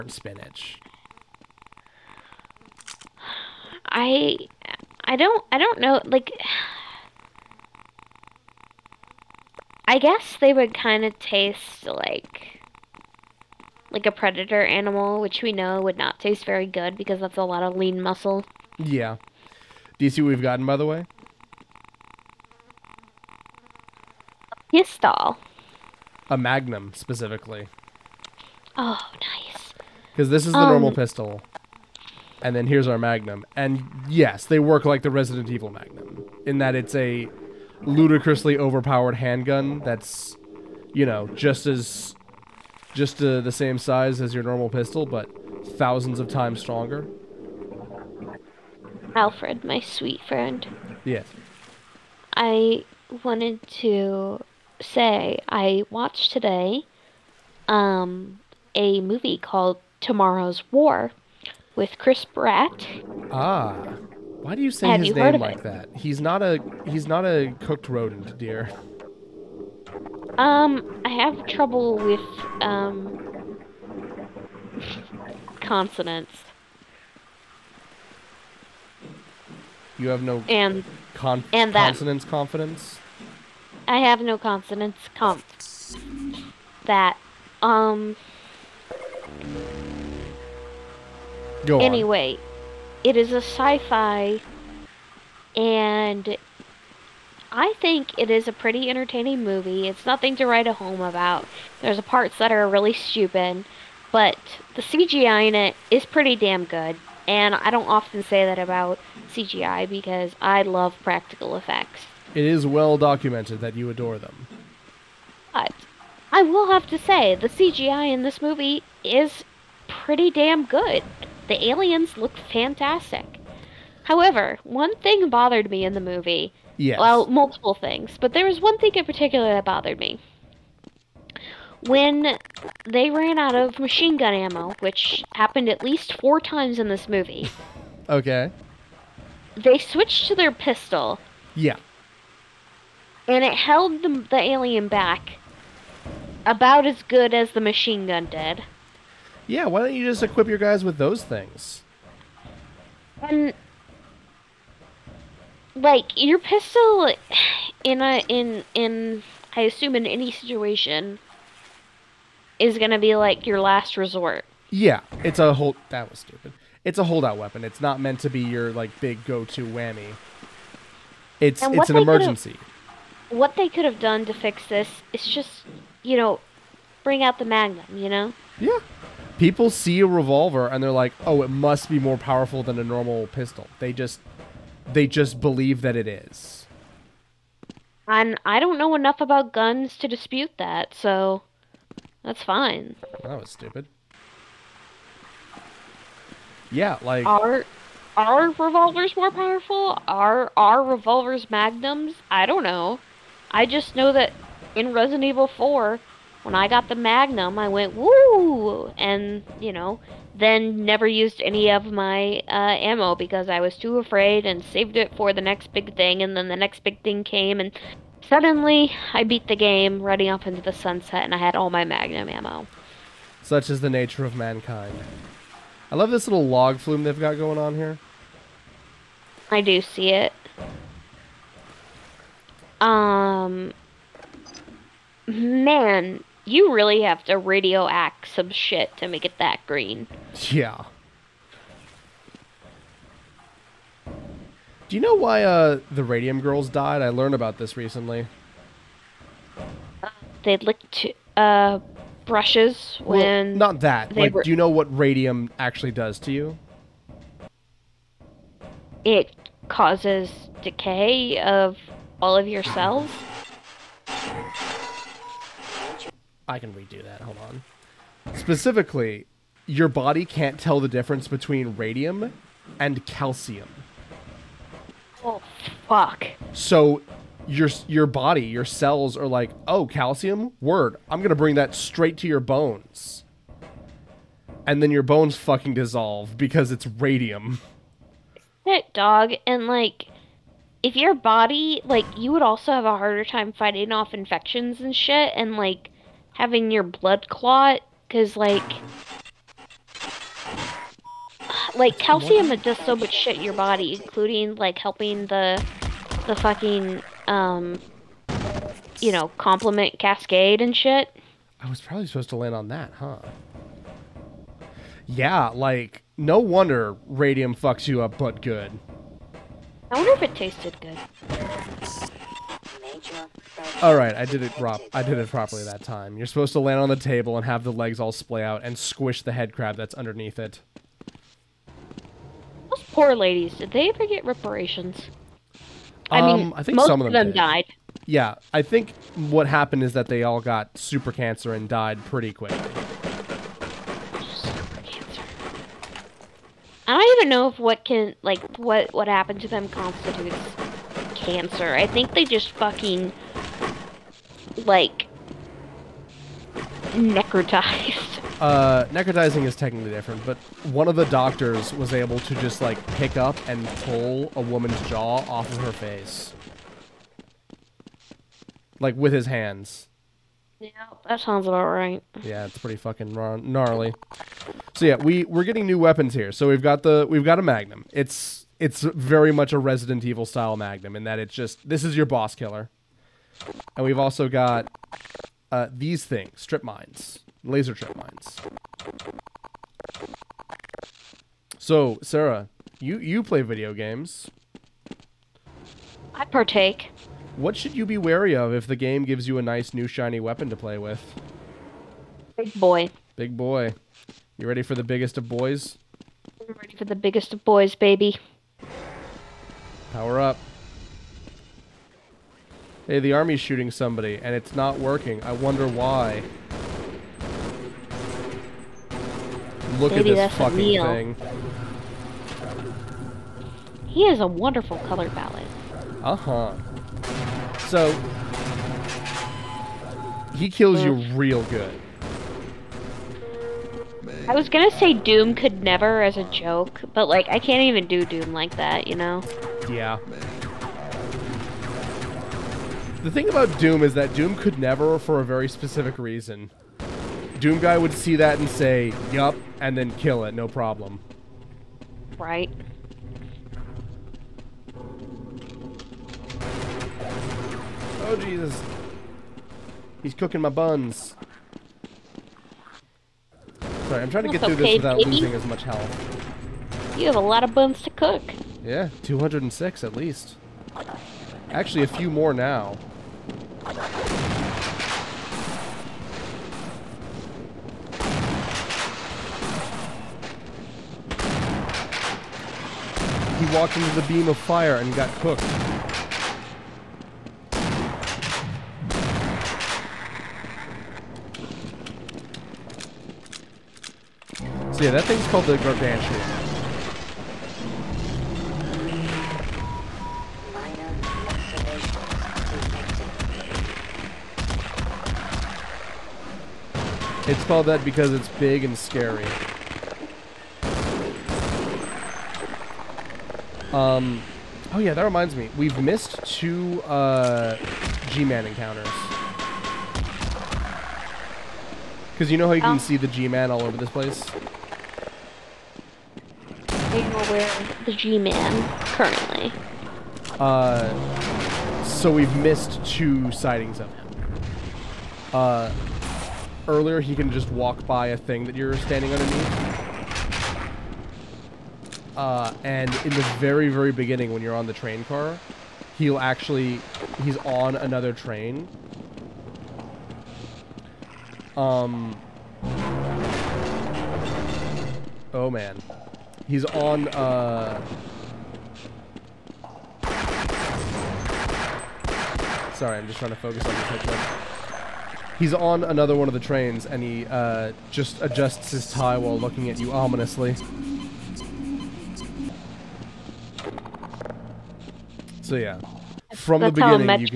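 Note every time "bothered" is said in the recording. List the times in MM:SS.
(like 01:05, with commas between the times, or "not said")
02:05, 02:09.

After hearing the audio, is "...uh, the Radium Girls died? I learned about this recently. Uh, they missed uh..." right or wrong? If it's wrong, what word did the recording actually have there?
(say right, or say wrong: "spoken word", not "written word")
wrong: "licked", not "missed".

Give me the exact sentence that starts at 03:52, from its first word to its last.
Um, man, you really have to radioact some shit to make it that green.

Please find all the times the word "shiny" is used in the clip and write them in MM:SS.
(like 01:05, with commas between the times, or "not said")
06:39.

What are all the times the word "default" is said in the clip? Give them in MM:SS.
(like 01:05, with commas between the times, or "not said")
not said.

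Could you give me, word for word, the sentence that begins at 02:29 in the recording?
Yeah, why don't you just equip your guys with those things?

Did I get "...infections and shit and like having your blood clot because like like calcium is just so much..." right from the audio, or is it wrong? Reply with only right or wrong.
right.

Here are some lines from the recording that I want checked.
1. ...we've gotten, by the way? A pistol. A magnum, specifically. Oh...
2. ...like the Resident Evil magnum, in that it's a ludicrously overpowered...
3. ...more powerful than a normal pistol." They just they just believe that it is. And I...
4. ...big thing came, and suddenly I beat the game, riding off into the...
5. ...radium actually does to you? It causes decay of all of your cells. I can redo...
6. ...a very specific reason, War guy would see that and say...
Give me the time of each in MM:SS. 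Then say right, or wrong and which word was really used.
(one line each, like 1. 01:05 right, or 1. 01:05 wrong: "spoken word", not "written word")
1. 00:20 right
2. 00:34 right
3. 03:01 right
4. 03:36 right
5. 04:14 right
6. 07:25 wrong: "Doom", not "War".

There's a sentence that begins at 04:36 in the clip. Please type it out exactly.
So your your body, your cells are like, "Oh, calcium?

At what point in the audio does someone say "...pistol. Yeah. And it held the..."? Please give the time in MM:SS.
02:20.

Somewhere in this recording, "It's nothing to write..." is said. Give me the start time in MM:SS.
01:39.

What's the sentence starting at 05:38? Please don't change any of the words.
Yeah, I think what happened is that they all got super cancer and died pretty quick.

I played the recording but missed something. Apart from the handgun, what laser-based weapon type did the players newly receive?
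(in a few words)
Laser strip mines.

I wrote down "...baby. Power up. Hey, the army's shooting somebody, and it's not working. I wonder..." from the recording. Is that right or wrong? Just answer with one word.
right.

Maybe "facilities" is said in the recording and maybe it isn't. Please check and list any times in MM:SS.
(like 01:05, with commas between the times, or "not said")
not said.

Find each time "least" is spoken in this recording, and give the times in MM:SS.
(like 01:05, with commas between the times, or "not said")
02:15, 07:49.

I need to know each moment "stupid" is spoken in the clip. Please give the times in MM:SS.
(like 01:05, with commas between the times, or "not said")
01:42, 02:46, 03:13.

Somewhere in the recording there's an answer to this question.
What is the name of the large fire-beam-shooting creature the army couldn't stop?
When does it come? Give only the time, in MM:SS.
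08:15.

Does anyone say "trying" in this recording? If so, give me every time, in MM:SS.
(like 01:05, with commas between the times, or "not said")
07:44, 09:23.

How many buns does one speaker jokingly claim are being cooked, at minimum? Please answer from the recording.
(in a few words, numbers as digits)
206.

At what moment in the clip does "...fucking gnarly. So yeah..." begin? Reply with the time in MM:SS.
06:12.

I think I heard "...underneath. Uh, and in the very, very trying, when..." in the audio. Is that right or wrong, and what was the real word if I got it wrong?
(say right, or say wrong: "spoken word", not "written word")
wrong: "beginning", not "trying".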